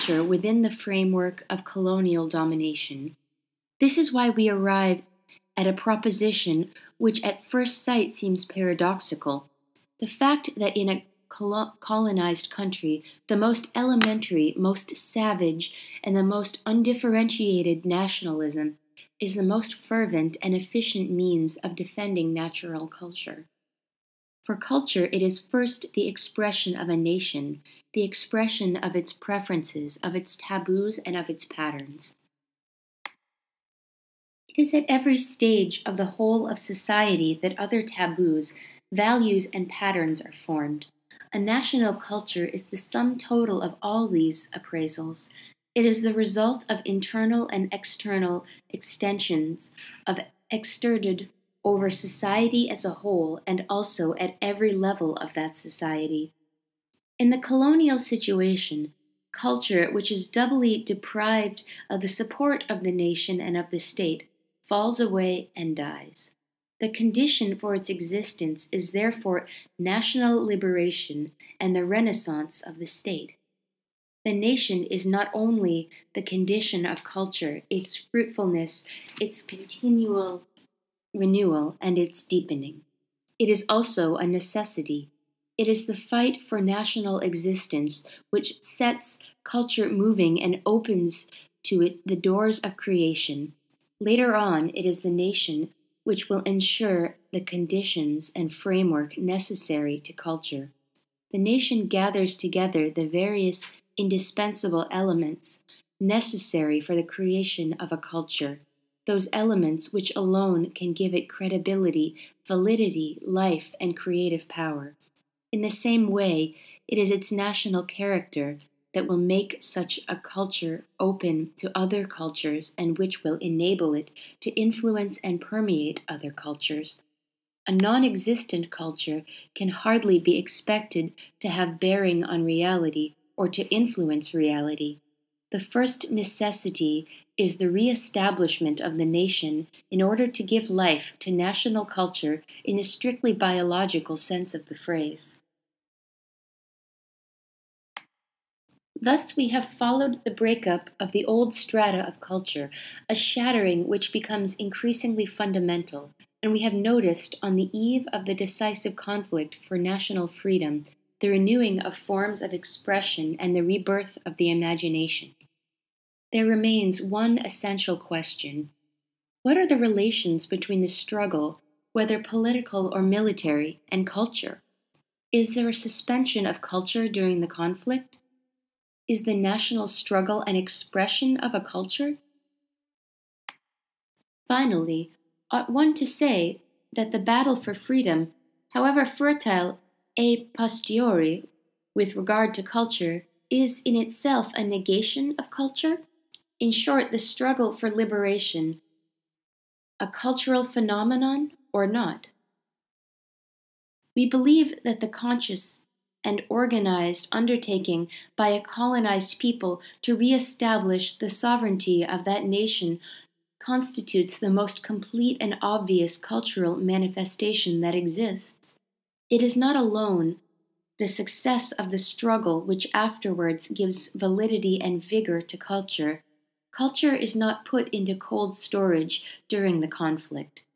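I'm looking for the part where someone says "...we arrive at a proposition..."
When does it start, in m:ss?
0:04.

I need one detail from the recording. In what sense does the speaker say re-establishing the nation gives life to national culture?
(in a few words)
strictly biological.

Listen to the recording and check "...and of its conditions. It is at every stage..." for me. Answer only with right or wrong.
wrong.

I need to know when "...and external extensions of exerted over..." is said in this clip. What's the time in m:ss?
0:47.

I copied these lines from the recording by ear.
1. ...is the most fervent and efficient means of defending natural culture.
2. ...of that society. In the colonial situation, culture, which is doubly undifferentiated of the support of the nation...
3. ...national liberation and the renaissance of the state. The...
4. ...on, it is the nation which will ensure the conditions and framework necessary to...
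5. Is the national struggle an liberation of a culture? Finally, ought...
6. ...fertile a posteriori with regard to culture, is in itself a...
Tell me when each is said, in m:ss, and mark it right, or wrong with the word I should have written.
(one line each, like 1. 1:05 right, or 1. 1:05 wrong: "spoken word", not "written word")
1. 0:19 right
2. 0:55 wrong: "deprived", not "undifferentiated"
3. 1:09 right
4. 1:34 right
5. 2:59 wrong: "expression", not "liberation"
6. 3:09 right.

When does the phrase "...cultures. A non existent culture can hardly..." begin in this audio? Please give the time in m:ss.
2:06.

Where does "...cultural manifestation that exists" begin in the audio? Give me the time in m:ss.
3:36.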